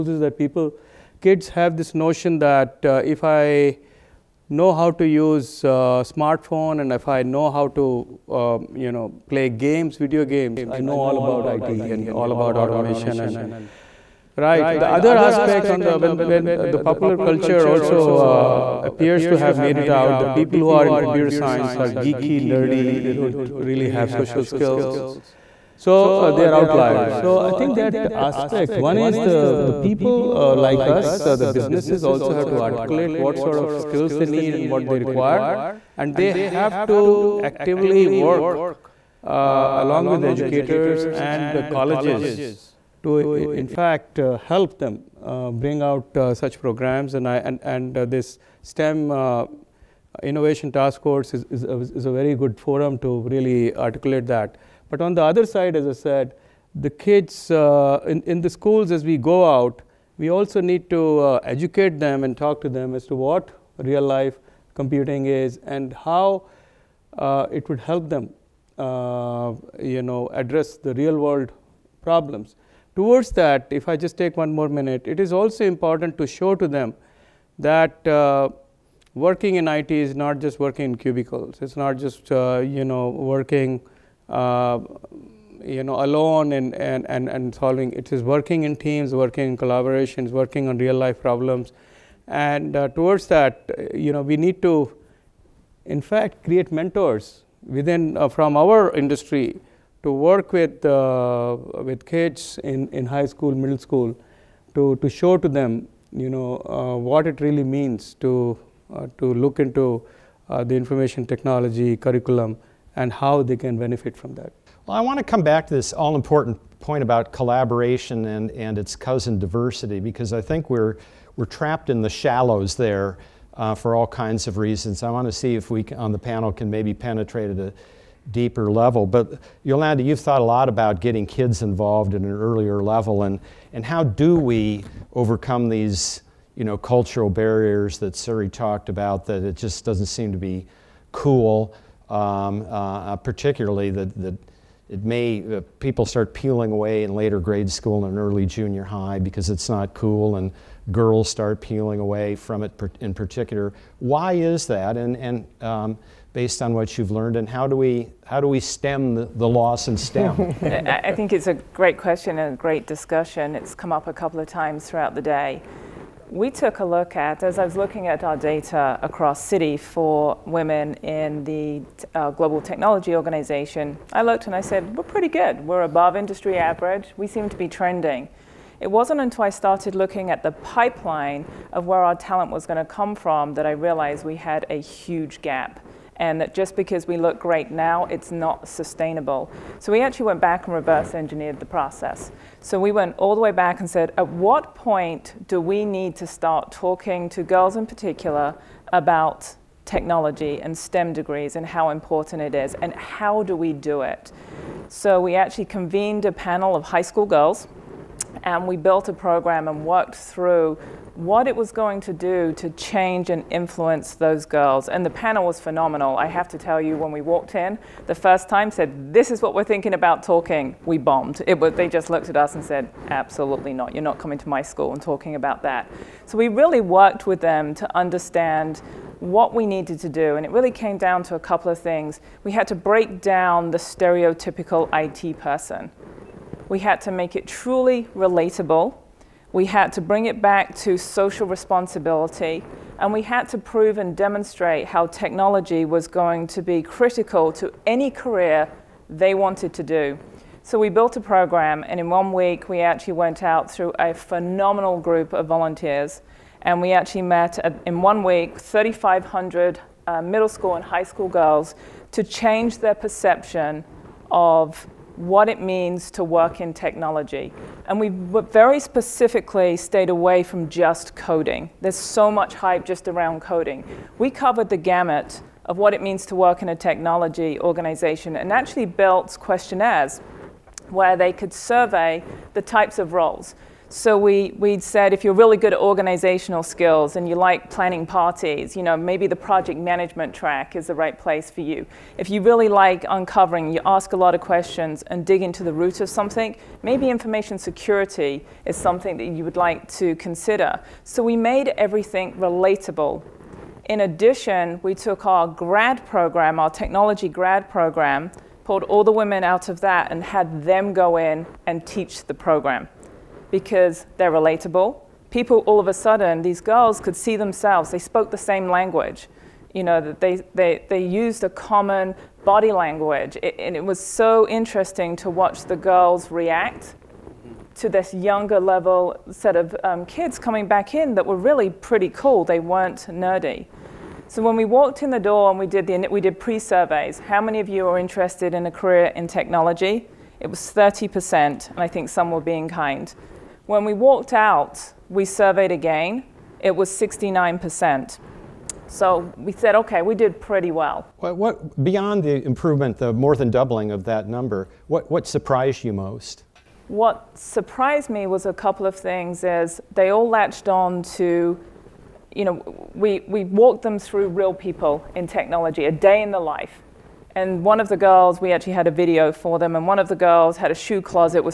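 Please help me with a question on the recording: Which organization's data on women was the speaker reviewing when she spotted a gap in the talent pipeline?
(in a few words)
Global Technology Organization.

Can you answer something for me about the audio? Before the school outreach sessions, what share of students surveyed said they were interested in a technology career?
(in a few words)
30%.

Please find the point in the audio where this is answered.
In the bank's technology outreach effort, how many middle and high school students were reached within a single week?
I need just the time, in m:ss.
4:18.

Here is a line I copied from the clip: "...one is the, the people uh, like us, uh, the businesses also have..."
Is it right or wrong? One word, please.
right.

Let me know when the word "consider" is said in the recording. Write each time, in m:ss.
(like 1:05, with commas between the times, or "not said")
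5:00.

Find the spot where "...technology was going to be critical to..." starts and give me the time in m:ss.
4:05.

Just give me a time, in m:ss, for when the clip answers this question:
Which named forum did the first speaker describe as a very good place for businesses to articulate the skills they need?
0:48.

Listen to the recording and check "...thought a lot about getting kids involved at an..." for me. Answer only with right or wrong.
right.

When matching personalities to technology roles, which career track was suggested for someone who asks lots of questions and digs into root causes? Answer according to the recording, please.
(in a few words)
information security.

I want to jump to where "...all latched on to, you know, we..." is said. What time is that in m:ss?
6:00.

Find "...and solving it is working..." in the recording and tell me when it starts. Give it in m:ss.
1:27.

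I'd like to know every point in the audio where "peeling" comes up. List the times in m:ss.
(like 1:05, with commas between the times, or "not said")
2:26, 2:31.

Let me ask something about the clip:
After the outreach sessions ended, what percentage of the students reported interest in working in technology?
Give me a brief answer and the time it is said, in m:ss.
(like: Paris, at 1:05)
69%, at 5:46.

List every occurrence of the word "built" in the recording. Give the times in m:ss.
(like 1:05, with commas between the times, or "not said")
3:28, 4:10, 4:38.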